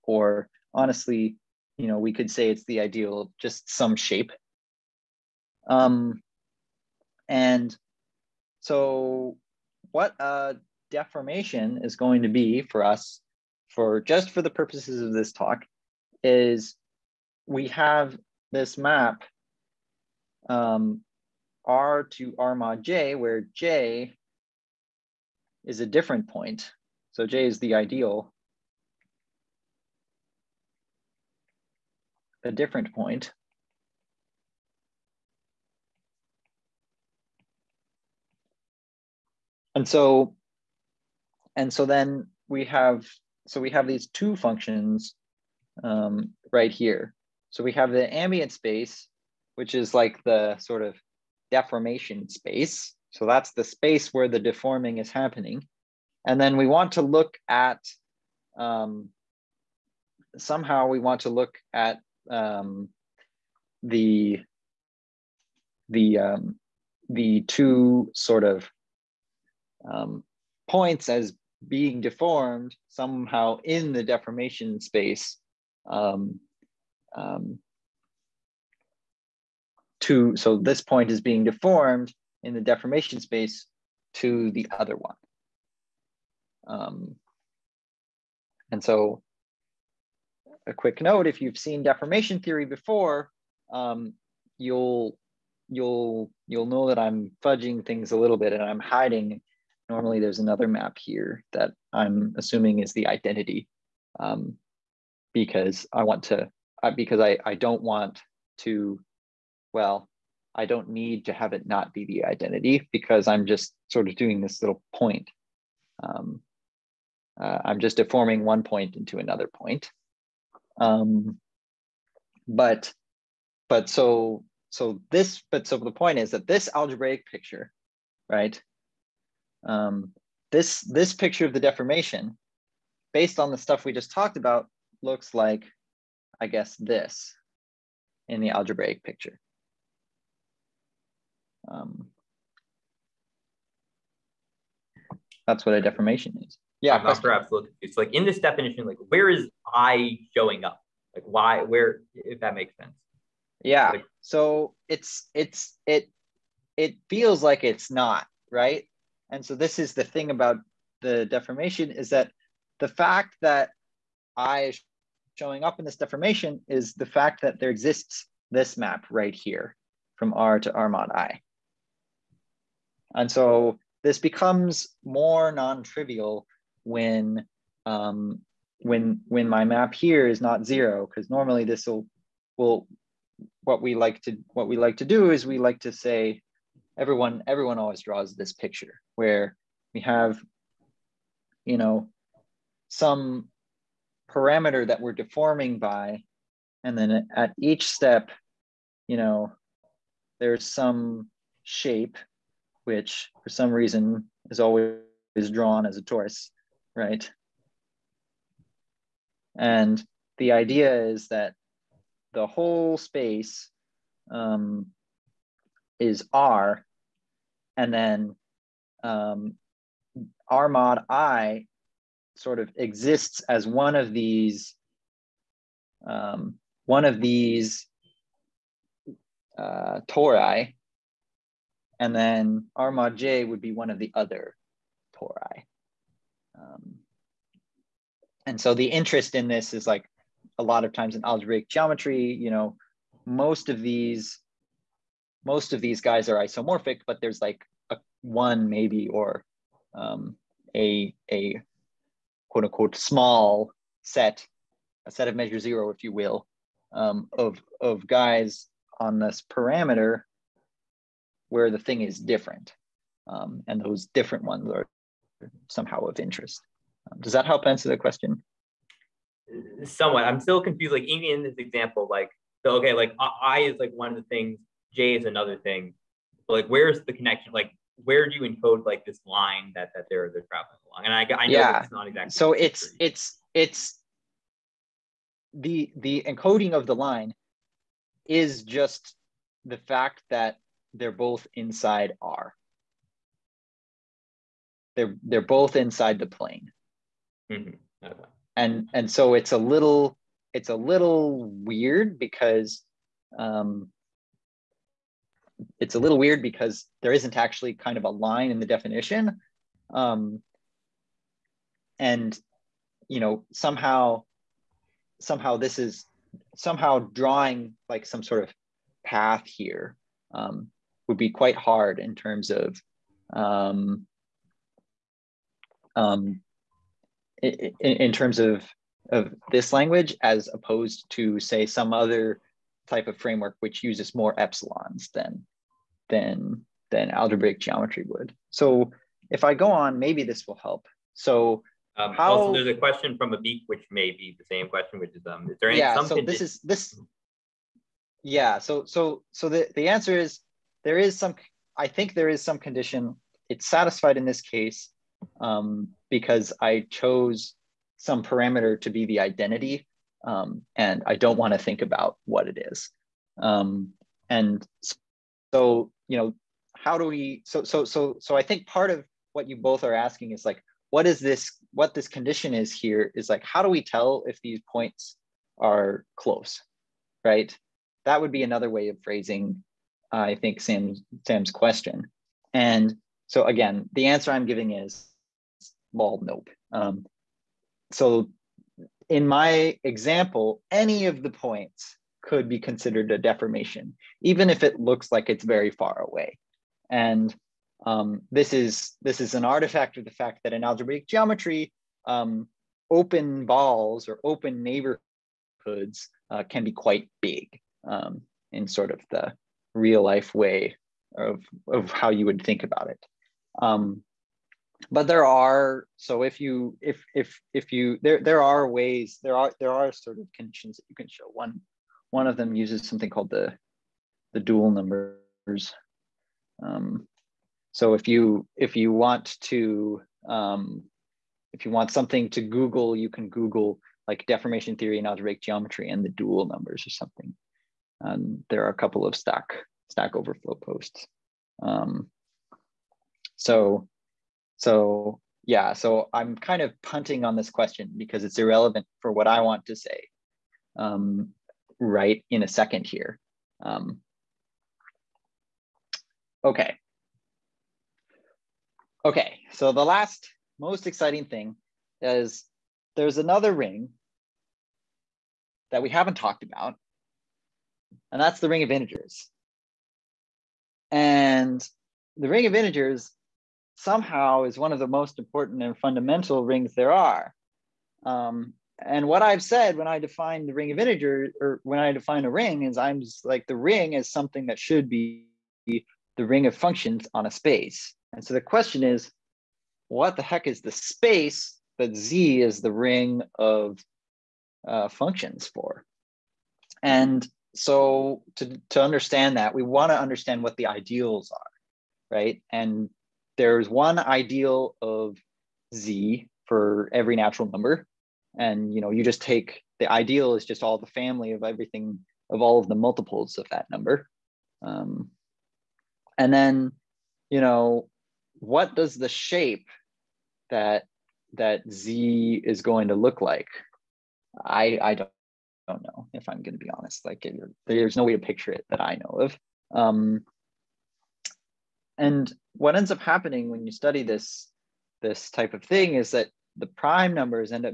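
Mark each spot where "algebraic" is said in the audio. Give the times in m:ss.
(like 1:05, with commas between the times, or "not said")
2:06, 2:18, 4:01, 5:37, 6:40, 7:15.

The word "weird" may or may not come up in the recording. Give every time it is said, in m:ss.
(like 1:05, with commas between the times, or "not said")
5:01, 5:06.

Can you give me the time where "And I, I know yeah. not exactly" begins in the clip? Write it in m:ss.
4:41.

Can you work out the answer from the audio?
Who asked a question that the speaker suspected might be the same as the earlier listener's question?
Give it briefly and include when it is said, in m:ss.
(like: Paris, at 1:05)
Abik, at 5:43.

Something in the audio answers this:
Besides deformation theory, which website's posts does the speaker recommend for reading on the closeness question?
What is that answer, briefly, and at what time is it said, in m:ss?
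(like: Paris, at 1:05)
Stack Overflow, at 7:19.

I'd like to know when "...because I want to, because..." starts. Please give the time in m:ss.
1:45.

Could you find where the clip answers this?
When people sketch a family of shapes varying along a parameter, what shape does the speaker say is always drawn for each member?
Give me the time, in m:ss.
3:25.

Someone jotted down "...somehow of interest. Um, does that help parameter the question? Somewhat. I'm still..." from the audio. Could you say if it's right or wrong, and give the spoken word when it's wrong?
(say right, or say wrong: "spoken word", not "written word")
wrong: "answer", not "parameter".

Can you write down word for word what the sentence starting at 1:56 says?
Um, uh, I'm just deforming one point into another point.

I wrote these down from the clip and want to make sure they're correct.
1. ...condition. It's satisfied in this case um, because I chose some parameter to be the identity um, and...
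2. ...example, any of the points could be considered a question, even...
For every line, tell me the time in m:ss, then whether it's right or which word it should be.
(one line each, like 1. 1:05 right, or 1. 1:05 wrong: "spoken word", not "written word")
1. 5:52 right
2. 6:29 wrong: "deformation", not "question".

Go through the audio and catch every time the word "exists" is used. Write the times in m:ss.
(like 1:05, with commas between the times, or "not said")
2:47, 3:42.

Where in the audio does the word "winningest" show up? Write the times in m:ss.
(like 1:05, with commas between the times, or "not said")
not said.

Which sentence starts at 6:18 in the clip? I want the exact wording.
That would be another way of phrasing I think Sam's Sam's question.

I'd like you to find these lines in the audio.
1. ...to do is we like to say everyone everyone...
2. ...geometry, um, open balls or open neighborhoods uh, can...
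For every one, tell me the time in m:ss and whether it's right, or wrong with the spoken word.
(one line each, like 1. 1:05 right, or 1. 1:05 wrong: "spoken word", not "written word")
1. 3:04 right
2. 6:41 right.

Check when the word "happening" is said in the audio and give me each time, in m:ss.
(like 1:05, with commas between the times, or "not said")
0:55, 8:53.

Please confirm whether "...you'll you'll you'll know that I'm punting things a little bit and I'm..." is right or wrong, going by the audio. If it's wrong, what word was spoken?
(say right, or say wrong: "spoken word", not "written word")
wrong: "fudging", not "punting".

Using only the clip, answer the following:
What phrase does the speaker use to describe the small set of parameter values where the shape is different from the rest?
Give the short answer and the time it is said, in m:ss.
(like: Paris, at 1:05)
a set of measure zero, at 4:15.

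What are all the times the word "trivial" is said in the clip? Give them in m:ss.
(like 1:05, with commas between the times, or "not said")
2:55.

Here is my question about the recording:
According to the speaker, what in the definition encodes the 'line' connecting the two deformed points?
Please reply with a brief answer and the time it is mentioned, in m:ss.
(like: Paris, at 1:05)
they're both inside R, at 4:50.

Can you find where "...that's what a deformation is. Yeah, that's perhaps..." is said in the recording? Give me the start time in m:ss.
2:25.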